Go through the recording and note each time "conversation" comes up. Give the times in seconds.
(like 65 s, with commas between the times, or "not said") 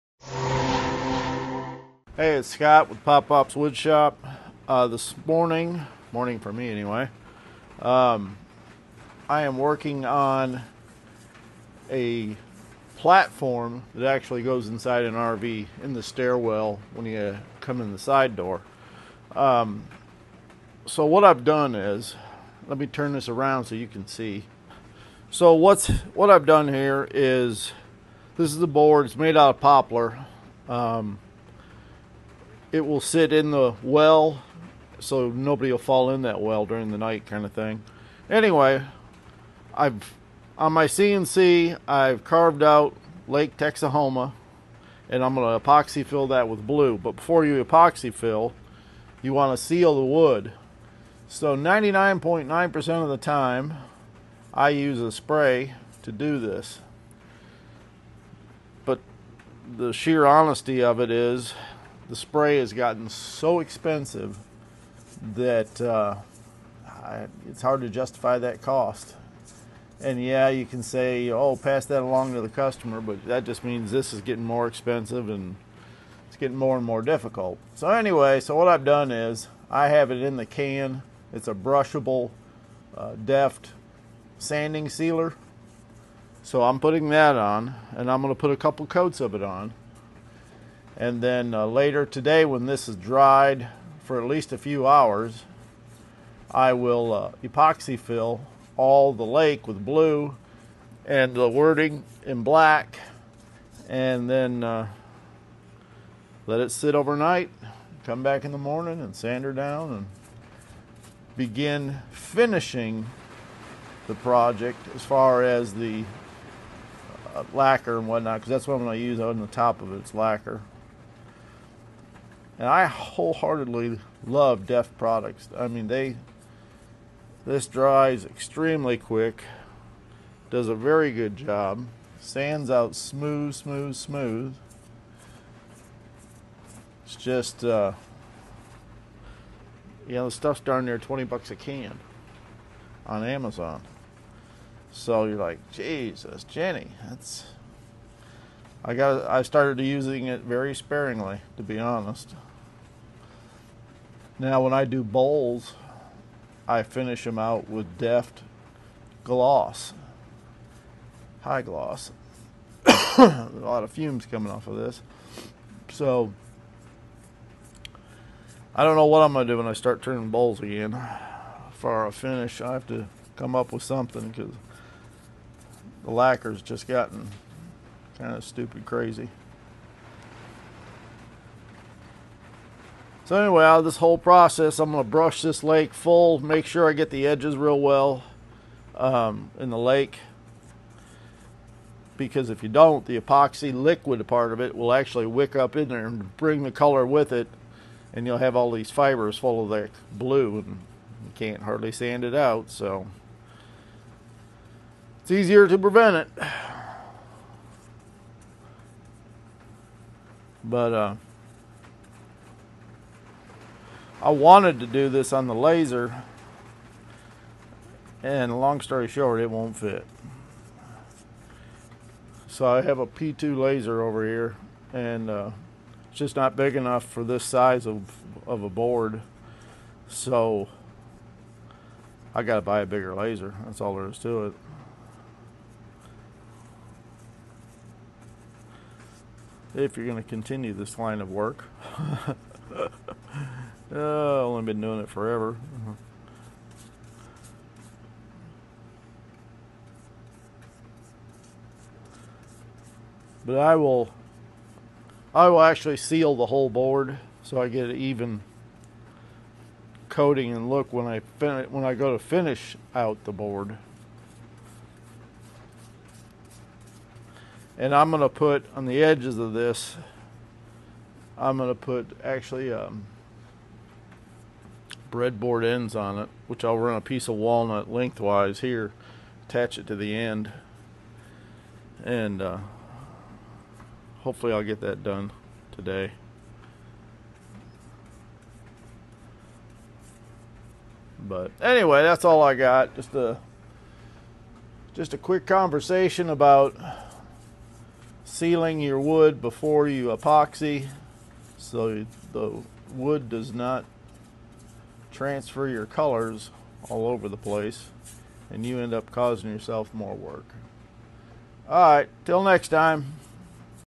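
295 s.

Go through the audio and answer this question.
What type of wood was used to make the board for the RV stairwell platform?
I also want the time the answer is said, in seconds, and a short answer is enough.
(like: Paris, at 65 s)
Poplar, at 29 s.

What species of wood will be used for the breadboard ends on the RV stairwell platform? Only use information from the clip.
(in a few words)
Walnut.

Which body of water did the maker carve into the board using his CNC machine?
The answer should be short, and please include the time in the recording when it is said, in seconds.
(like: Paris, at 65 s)
Lake Texahoma, at 43 s.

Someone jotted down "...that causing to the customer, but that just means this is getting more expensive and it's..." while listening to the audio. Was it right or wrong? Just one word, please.
wrong.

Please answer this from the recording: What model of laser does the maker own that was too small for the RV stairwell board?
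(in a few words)
P2.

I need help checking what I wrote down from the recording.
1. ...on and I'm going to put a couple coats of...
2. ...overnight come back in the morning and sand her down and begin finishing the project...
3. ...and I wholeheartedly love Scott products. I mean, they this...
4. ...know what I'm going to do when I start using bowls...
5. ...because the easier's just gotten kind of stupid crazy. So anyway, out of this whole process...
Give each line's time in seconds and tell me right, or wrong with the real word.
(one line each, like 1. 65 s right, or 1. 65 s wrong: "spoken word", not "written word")
1. 87 s right
2. 106 s right
3. 122 s wrong: "Deft", not "Scott"
4. 168 s wrong: "turning", not "using"
5. 174 s wrong: "lacquer", not "easier".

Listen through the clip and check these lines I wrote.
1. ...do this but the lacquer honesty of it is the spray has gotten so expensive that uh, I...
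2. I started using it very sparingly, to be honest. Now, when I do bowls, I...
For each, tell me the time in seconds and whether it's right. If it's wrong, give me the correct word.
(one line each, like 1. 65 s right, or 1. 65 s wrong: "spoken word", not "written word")
1. 56 s wrong: "sheer", not "lacquer"
2. 149 s right.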